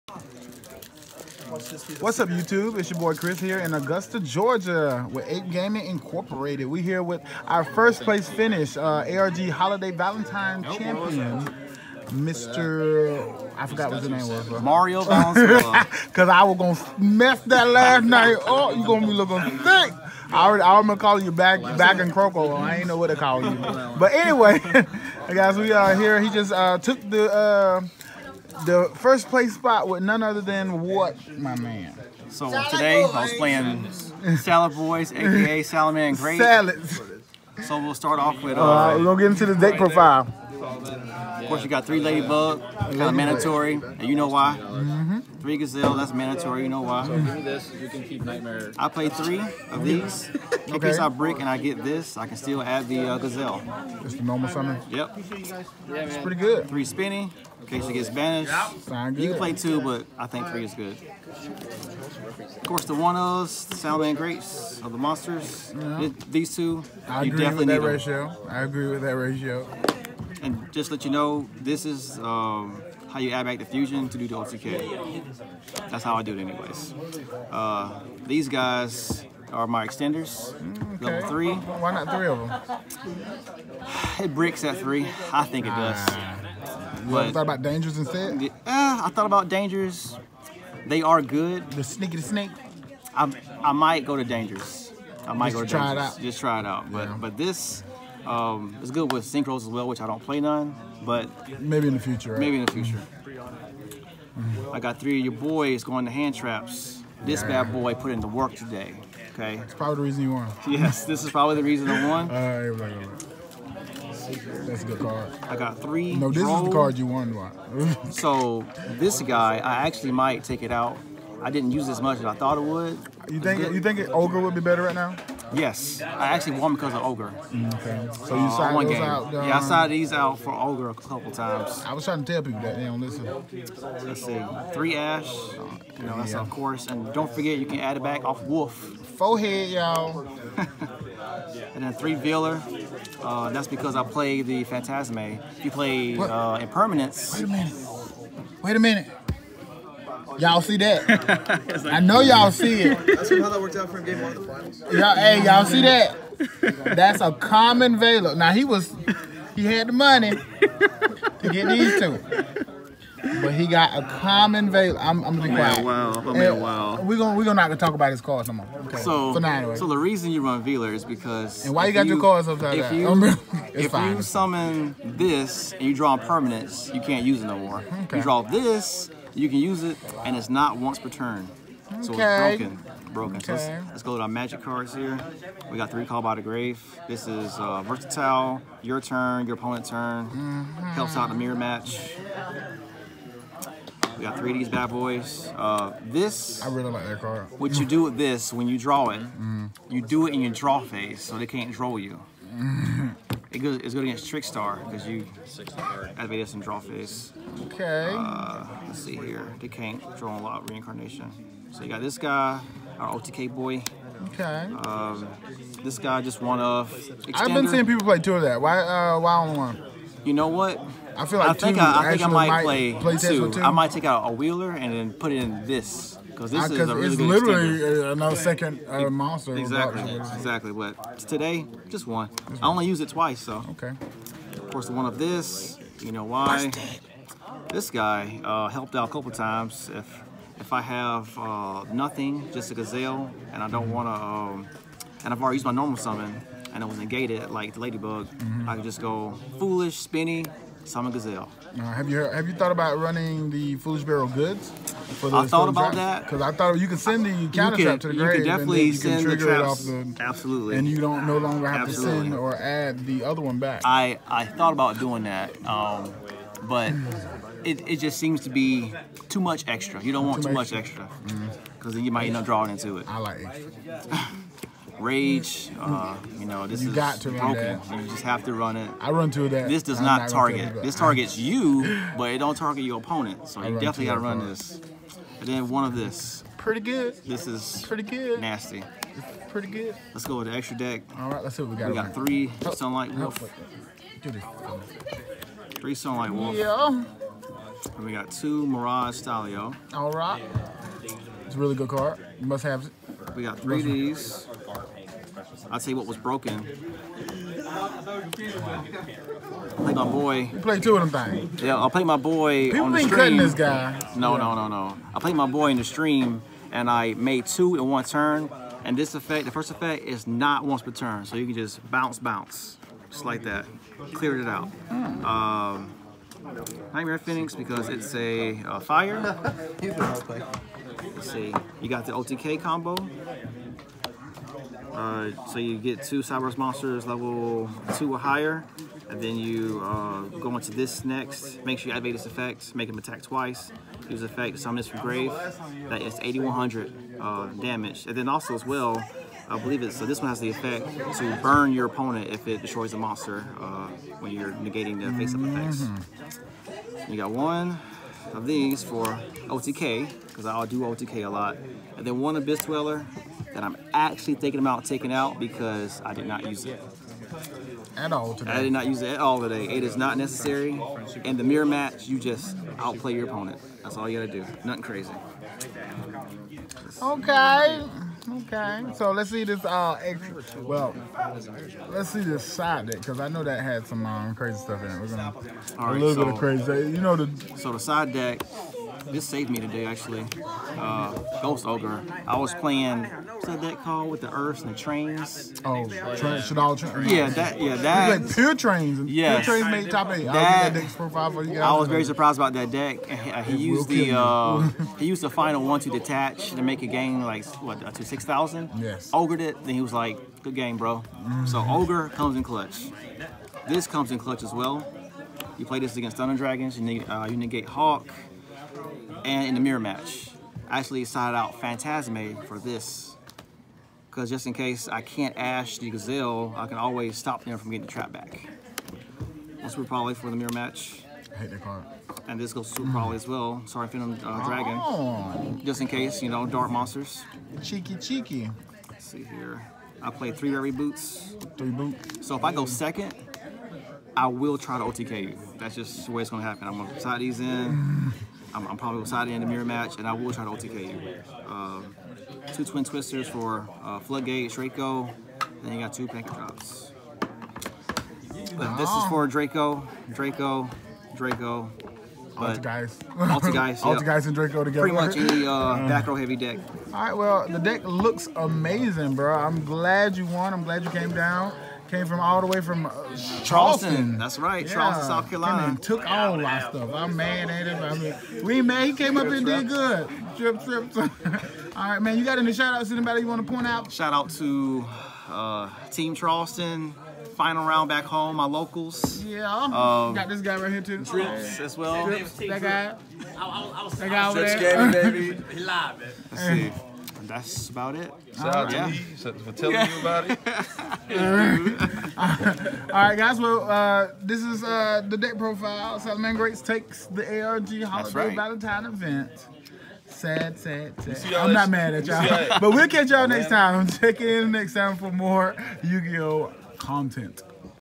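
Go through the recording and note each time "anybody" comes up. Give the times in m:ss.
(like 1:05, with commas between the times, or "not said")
8:02.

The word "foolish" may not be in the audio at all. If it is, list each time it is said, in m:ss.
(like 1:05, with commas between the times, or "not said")
4:09, 4:13.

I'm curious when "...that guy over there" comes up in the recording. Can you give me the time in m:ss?
8:13.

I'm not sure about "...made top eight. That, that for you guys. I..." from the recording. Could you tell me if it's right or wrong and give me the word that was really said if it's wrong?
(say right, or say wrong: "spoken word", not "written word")
right.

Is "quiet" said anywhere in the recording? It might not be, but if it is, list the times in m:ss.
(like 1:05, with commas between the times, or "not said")
2:45.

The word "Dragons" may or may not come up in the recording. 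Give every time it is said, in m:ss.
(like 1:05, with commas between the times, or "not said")
6:56, 7:14.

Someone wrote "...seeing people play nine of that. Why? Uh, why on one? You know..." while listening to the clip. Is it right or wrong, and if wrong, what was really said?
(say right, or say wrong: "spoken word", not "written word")
wrong: "two", not "nine".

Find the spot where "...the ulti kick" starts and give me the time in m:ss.
1:14.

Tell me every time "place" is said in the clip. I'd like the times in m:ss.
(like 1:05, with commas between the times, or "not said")
0:08, 0:29.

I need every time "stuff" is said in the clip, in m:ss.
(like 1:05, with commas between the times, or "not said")
6:24, 7:56.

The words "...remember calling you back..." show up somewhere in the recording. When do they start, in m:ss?
0:20.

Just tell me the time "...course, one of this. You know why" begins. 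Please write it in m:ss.
3:54.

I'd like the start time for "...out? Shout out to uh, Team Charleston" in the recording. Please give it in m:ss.
8:03.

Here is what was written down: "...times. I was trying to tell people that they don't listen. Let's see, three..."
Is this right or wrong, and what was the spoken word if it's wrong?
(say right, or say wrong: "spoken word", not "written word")
right.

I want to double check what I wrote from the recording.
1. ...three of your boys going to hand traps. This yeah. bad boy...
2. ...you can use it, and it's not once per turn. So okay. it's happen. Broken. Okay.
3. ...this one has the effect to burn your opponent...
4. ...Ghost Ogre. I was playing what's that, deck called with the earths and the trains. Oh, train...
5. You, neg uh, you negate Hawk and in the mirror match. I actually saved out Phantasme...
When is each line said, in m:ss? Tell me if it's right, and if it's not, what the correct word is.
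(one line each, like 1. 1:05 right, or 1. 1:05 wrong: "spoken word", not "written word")
1. 1:44 right
2. 2:59 wrong: "broken", not "happen"
3. 5:50 right
4. 6:31 right
5. 6:56 wrong: "signed", not "saved".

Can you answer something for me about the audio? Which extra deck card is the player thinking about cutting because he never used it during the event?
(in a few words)
Abyss Dweller.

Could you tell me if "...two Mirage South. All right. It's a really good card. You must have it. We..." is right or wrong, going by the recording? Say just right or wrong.
wrong.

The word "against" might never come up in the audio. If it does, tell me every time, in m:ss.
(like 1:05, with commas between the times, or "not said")
3:24, 6:55.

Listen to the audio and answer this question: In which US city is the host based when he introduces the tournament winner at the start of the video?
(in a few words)
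Augusta, Georgia.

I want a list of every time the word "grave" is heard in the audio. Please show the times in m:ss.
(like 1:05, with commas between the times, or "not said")
3:06, 4:18, 5:44.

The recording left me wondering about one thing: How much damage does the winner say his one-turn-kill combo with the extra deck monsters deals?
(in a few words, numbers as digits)
8100.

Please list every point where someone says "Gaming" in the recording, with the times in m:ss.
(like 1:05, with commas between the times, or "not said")
0:05.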